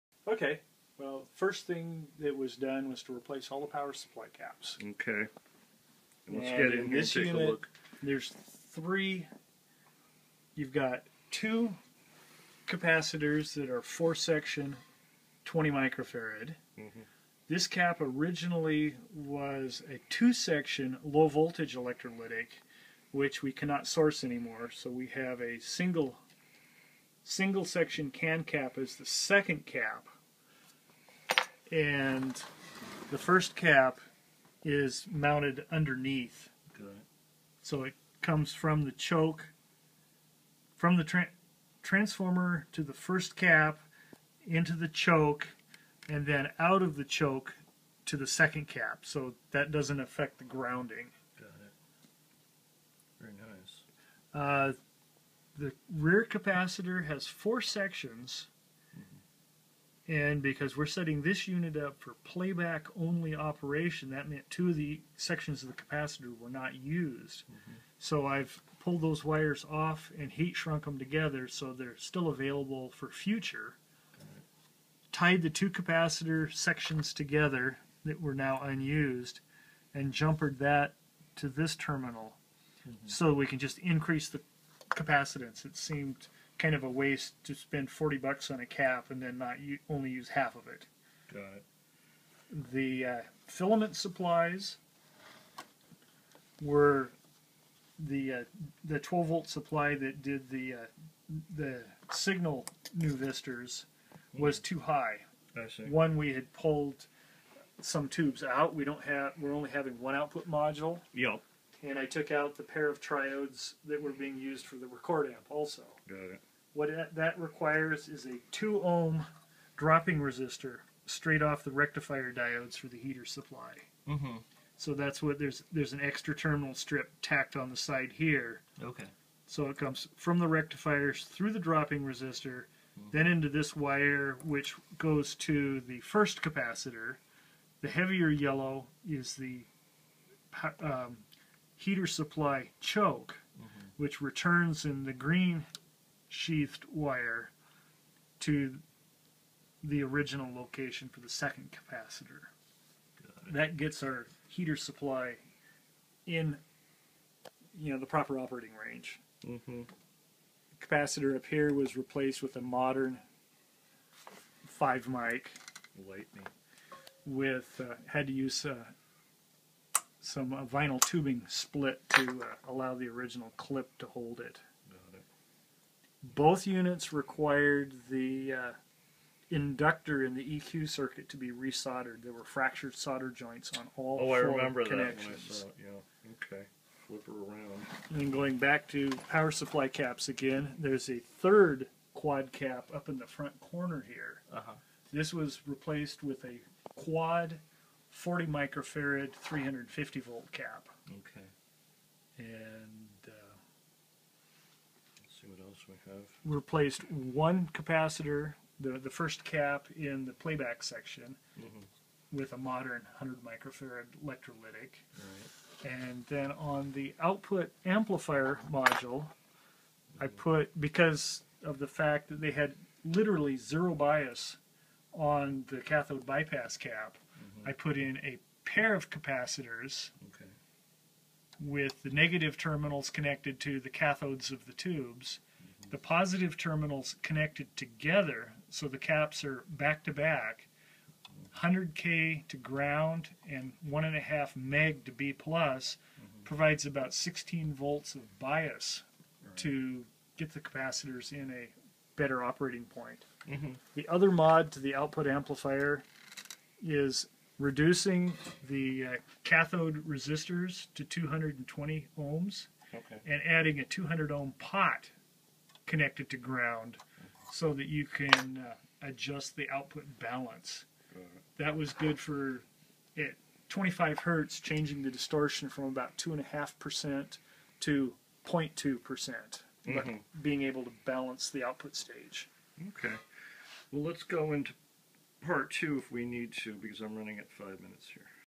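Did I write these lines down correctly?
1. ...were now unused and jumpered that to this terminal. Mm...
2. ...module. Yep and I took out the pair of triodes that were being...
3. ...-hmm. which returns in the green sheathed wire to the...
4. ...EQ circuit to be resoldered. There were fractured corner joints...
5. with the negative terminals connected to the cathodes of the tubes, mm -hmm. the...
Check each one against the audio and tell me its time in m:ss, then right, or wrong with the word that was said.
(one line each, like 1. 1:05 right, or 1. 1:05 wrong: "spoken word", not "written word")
1. 1:18 right
2. 1:50 right
3. 2:23 right
4. 3:00 wrong: "solder", not "corner"
5. 3:51 right.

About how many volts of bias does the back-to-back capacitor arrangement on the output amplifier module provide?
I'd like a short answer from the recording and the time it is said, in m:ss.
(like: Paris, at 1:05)
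16 volts, at 4:07.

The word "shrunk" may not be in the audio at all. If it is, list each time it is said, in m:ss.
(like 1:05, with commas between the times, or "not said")
1:10.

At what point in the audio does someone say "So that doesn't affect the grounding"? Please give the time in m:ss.
0:49.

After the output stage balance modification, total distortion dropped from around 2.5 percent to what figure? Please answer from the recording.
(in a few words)
0.2%.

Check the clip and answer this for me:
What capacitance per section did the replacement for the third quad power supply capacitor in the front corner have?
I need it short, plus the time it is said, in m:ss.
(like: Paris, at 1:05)
40 microfarad, at 3:18.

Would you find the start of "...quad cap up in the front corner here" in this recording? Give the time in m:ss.
3:12.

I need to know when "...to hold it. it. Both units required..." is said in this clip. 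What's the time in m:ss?
2:53.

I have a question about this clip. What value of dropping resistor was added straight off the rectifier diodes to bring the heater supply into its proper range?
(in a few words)
2 ohm.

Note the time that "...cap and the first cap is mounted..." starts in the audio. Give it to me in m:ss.
0:29.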